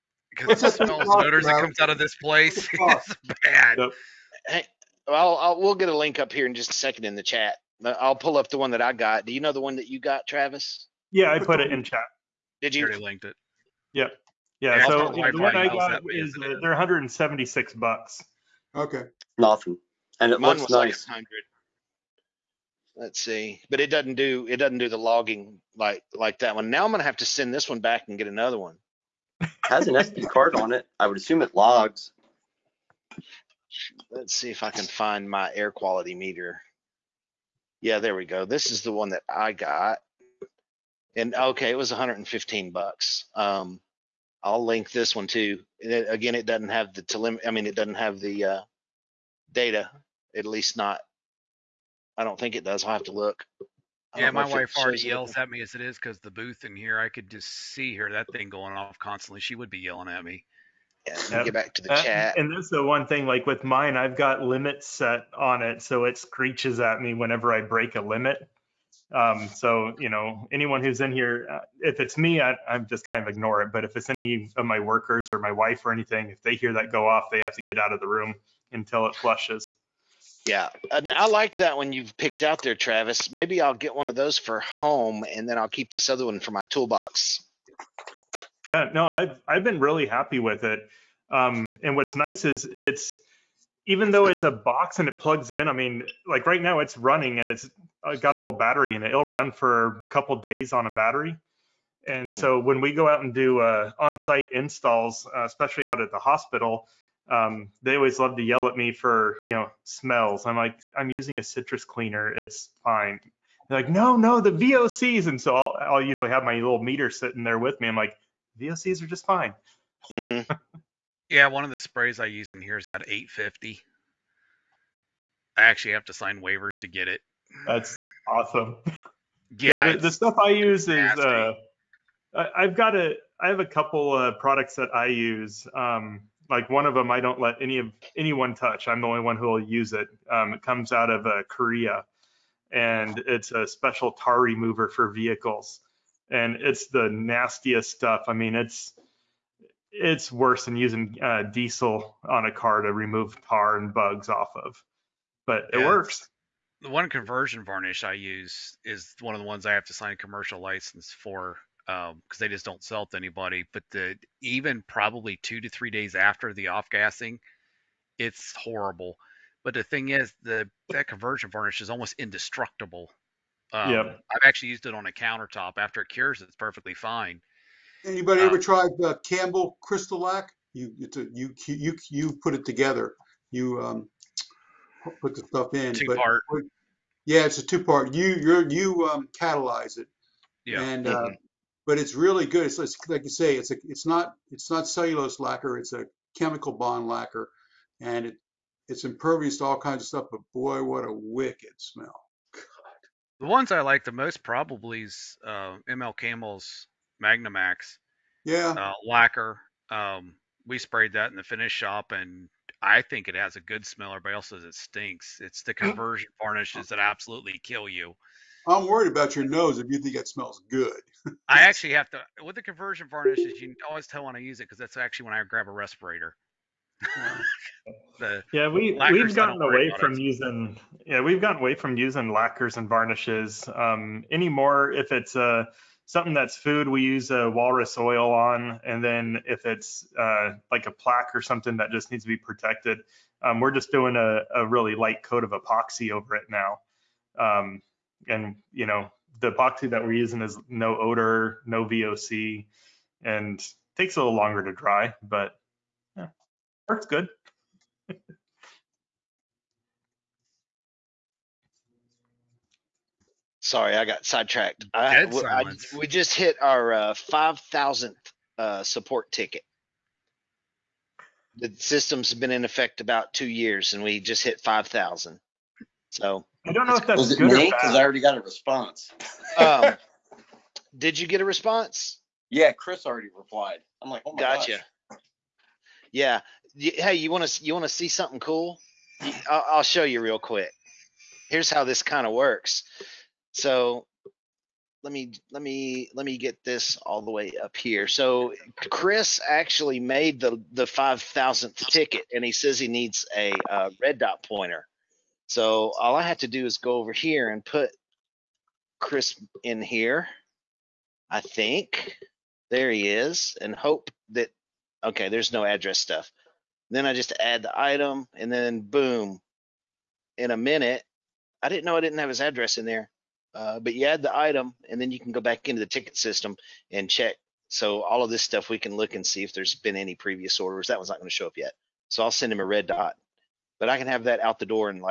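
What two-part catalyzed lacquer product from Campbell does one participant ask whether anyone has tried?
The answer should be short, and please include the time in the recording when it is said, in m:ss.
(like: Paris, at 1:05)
Crystal Lac, at 2:59.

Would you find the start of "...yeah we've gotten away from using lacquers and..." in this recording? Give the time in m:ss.
3:51.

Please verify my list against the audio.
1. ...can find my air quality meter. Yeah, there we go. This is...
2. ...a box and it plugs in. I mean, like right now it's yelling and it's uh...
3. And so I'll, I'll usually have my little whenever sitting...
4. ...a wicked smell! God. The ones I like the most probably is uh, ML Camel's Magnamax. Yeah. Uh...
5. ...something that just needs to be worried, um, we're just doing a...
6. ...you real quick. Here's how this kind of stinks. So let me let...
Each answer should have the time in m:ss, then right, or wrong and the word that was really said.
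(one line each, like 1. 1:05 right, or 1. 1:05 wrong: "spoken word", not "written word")
1. 0:34 right
2. 1:34 wrong: "running", not "yelling"
3. 1:55 wrong: "meter", not "whenever"
4. 3:21 right
5. 4:01 wrong: "protected", not "worried"
6. 4:50 wrong: "works", not "stinks".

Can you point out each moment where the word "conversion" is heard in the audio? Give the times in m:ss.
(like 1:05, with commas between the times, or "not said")
2:37, 2:51, 3:35, 3:42.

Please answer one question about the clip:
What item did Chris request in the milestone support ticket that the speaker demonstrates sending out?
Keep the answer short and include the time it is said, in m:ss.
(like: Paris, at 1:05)
red dot pointer, at 5:04.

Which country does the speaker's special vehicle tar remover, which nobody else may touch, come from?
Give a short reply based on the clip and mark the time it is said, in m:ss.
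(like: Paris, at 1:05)
Korea, at 2:21.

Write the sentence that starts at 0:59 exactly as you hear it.
She would be yelling at me.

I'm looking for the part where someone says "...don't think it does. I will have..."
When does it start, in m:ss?
0:52.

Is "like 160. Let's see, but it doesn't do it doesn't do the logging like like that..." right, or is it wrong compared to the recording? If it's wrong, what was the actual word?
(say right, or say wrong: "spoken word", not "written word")
wrong: "100", not "160".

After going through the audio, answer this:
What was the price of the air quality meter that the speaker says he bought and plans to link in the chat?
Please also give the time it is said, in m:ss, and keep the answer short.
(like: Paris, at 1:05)
$115, at 0:41.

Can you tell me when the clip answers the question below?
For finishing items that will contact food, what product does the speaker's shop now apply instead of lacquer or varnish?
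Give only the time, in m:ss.
3:57.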